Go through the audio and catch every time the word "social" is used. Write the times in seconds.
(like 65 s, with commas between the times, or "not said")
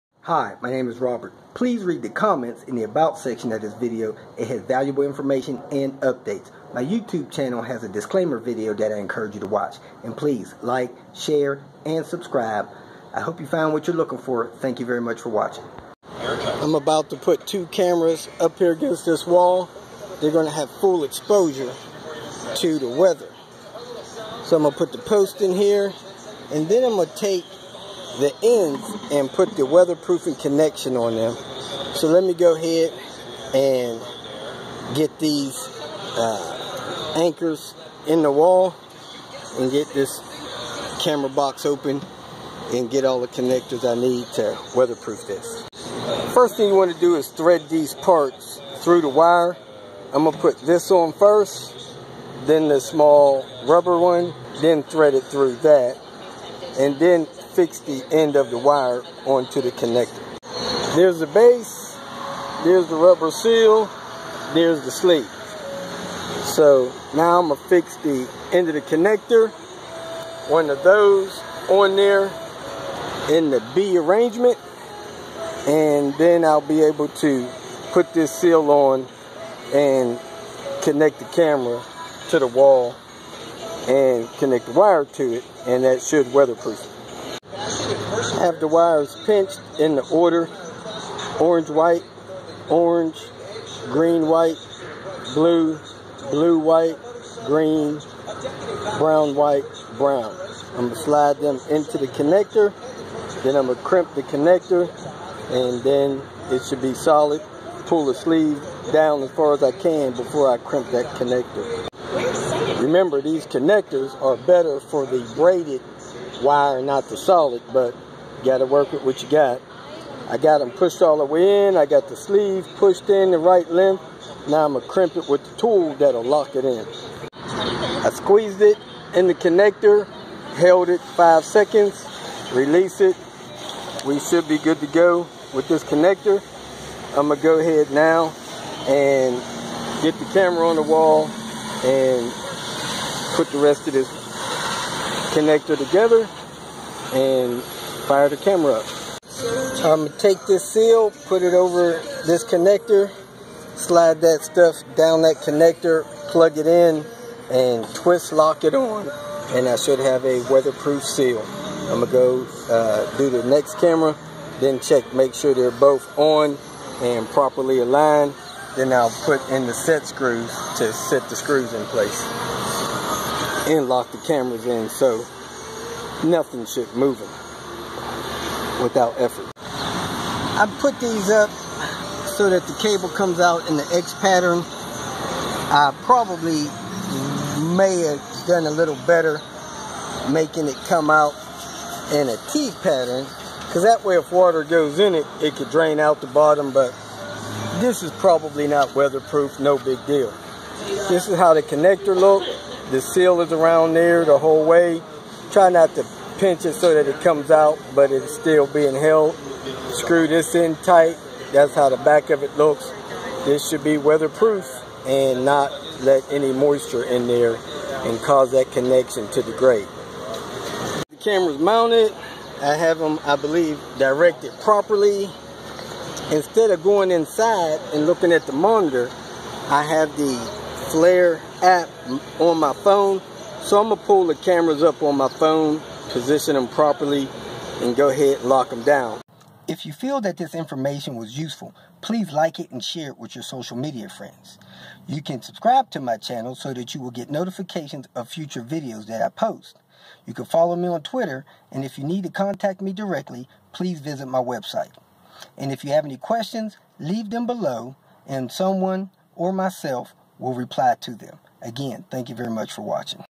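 243 s.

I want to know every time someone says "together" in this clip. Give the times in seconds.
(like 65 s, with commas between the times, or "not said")
145 s.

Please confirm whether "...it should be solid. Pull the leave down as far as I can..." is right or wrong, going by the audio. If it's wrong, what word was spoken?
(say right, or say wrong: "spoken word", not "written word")
wrong: "sleeve", not "leave".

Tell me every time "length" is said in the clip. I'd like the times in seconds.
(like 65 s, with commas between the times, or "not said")
123 s.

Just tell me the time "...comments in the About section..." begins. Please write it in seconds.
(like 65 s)
2 s.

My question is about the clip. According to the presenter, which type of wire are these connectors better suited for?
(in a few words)
Braided wire.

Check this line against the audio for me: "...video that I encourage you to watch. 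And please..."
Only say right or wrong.
right.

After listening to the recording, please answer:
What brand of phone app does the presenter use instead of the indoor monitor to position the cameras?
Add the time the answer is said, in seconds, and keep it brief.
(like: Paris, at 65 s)
Flir, at 230 s.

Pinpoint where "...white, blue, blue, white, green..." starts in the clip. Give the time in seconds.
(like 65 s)
94 s.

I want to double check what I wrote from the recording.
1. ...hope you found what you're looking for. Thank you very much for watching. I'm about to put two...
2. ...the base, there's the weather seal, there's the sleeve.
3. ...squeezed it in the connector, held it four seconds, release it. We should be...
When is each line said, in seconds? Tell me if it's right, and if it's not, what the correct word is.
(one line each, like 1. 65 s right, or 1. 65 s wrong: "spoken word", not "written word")
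1. 13 s right
2. 61 s wrong: "rubber", not "weather"
3. 128 s wrong: "five", not "four".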